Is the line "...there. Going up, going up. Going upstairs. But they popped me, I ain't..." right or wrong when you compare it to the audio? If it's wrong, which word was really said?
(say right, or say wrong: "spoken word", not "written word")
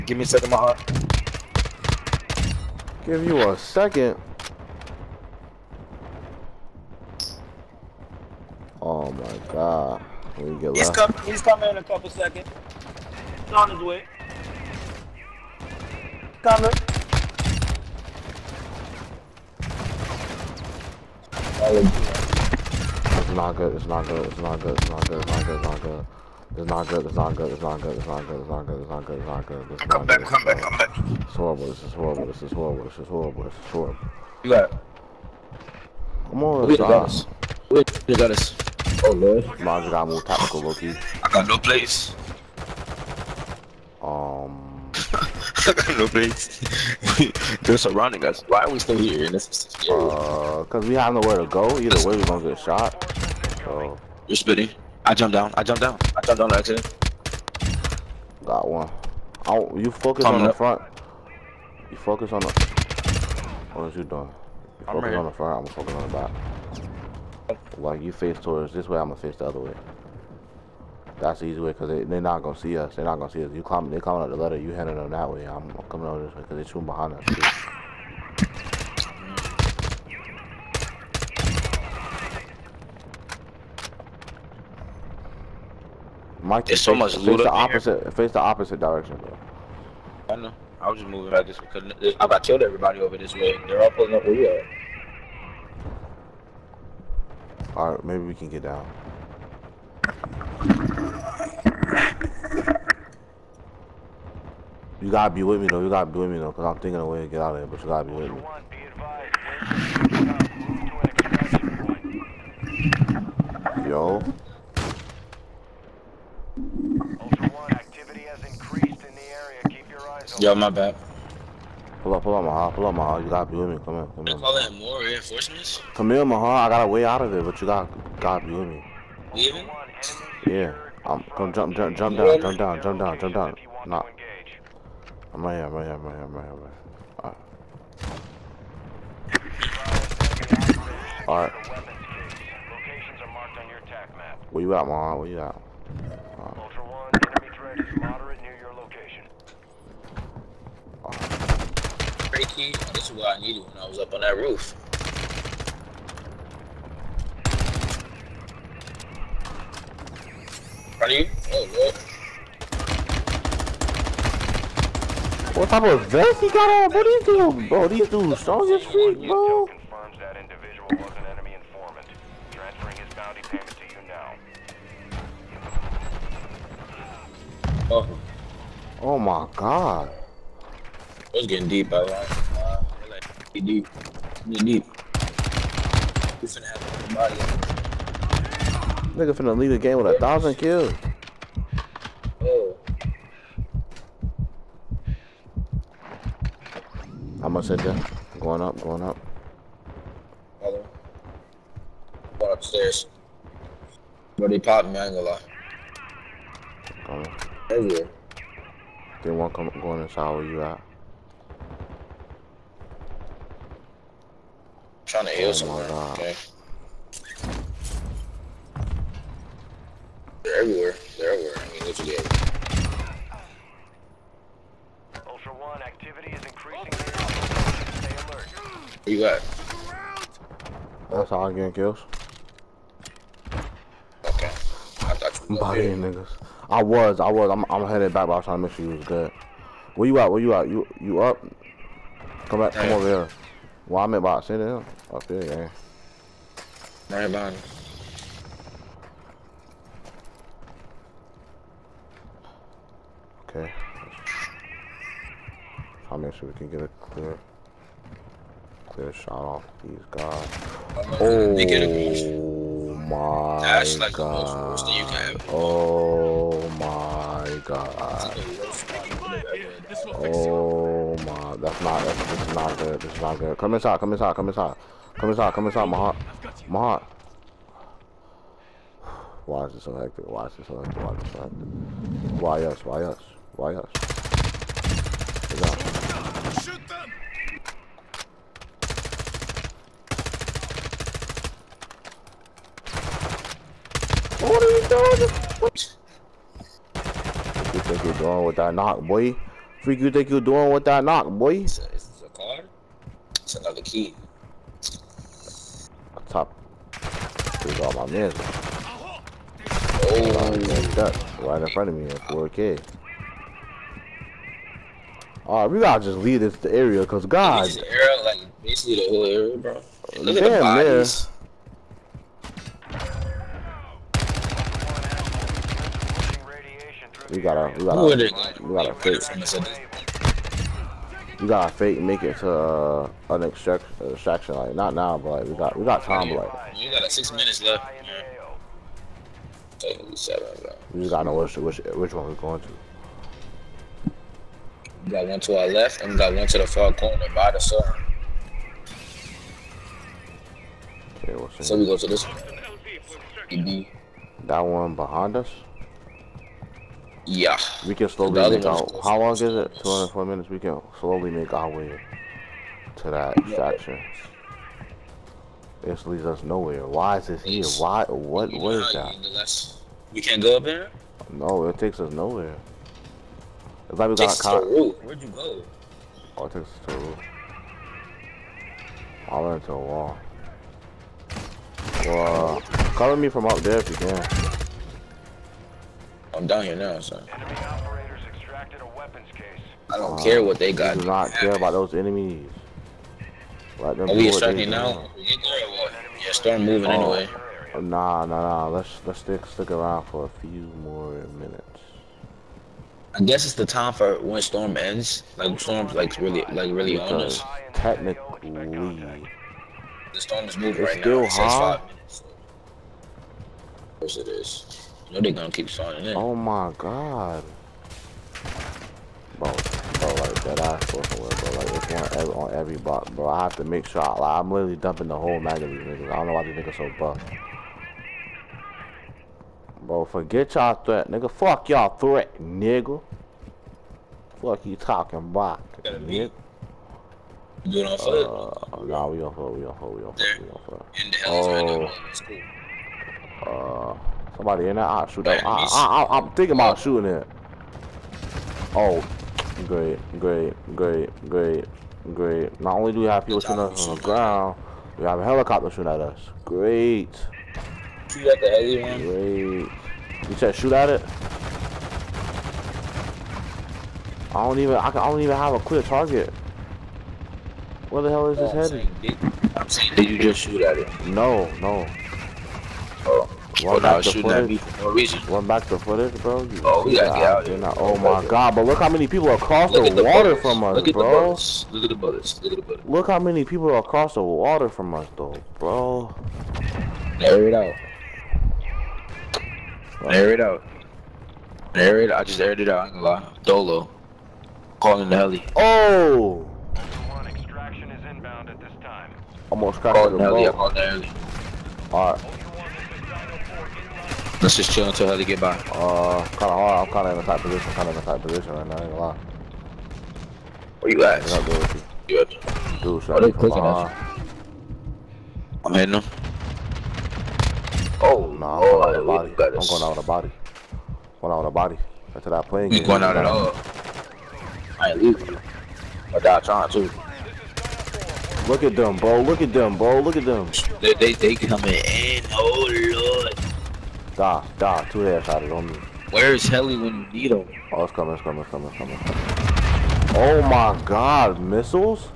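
right.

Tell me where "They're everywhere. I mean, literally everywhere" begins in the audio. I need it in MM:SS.
03:41.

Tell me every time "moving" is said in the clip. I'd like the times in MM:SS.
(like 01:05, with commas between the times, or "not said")
01:31, 06:36, 06:50.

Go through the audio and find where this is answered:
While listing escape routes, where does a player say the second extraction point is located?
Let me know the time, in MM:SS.
05:46.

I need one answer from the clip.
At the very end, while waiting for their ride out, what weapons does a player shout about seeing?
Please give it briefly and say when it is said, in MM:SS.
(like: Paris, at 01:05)
Missiles, at 09:01.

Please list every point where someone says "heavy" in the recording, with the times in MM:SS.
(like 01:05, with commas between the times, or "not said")
07:38.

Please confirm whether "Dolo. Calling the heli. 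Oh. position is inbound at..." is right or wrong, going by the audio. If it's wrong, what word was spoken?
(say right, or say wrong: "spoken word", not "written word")
wrong: "extraction", not "position".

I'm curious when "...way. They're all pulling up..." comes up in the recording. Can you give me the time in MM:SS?
01:33.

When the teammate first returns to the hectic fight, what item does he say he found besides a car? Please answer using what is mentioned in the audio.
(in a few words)
Another key.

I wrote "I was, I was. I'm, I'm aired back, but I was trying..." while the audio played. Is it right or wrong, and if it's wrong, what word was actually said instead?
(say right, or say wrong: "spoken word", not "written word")
wrong: "headed", not "aired".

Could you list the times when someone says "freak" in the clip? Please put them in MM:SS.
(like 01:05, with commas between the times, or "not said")
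02:48, 04:59.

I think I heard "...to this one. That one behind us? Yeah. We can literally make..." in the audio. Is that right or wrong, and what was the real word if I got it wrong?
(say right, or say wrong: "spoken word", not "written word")
wrong: "slowly", not "literally".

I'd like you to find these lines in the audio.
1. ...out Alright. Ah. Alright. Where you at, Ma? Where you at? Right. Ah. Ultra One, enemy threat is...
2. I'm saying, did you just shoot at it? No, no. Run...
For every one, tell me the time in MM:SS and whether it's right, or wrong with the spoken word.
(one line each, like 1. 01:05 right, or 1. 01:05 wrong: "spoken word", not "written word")
1. 02:16 right
2. 07:49 right.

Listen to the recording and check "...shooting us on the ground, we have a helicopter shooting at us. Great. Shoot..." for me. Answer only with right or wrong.
right.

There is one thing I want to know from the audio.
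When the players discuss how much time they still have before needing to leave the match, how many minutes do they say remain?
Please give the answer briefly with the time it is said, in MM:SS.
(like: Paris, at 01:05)
6, at 05:37.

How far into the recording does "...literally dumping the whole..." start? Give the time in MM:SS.
07:04.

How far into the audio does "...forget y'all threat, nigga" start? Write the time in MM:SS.
07:10.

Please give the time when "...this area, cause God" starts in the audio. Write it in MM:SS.
05:16.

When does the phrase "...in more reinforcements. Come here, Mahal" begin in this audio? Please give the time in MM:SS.
02:04.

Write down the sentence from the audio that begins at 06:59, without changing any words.
Bro, bro, like that I fucking with, bro.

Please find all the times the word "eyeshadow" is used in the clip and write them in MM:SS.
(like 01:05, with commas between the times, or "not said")
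not said.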